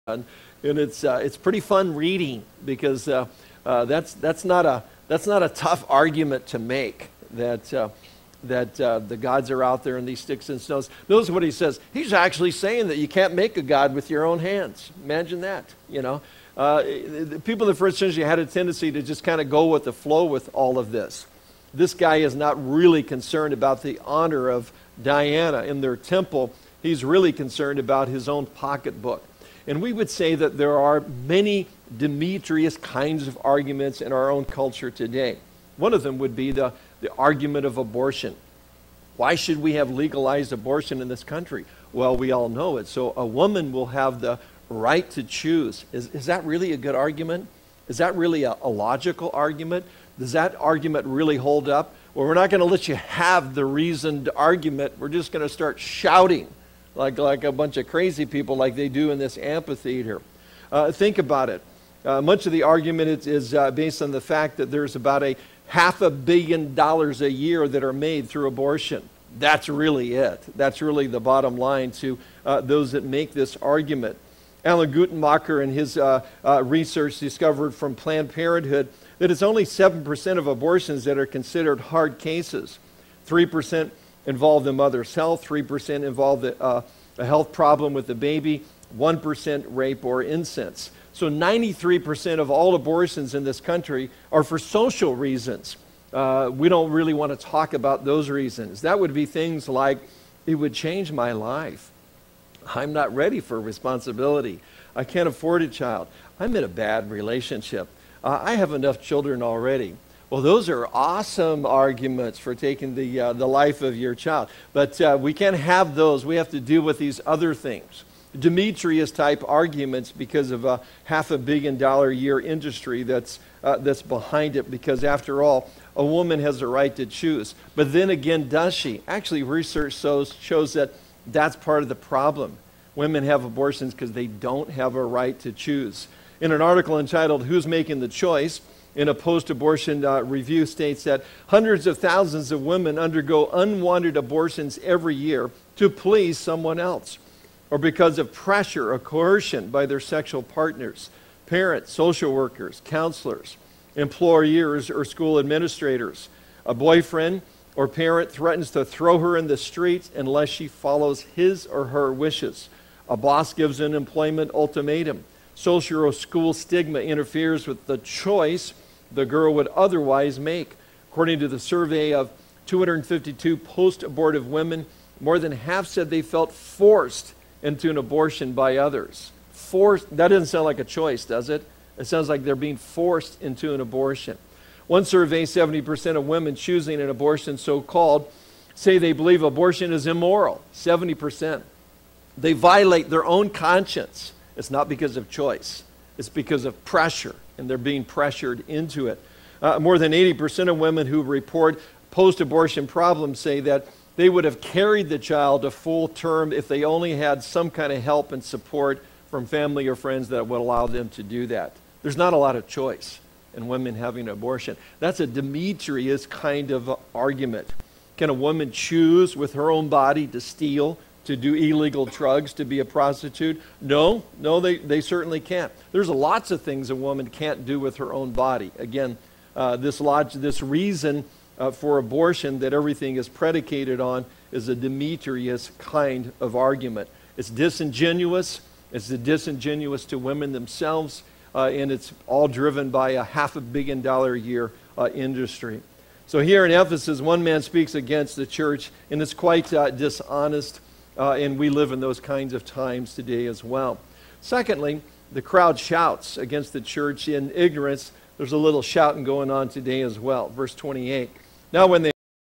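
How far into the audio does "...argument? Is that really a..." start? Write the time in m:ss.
0:46.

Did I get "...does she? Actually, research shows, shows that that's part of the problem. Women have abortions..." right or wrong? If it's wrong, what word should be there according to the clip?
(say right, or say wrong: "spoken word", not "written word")
right.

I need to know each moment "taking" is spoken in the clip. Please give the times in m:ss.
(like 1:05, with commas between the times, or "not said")
1:52.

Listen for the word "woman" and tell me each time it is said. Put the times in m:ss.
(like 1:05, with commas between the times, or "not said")
0:43, 2:06, 3:38, 3:46.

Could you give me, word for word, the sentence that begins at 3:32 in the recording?
There's not a lot of choice in women having an abortion.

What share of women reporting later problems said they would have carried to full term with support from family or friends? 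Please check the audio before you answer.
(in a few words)
more than 80%.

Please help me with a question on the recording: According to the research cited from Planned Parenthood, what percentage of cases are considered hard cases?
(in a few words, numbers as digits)
7%.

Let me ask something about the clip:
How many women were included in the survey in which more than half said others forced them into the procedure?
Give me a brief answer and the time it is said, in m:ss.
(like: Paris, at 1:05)
252, at 2:52.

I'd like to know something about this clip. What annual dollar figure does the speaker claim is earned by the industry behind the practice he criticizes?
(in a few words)
half a billion dollars.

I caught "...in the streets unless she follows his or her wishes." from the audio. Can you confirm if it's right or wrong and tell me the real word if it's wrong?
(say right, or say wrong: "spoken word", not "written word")
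right.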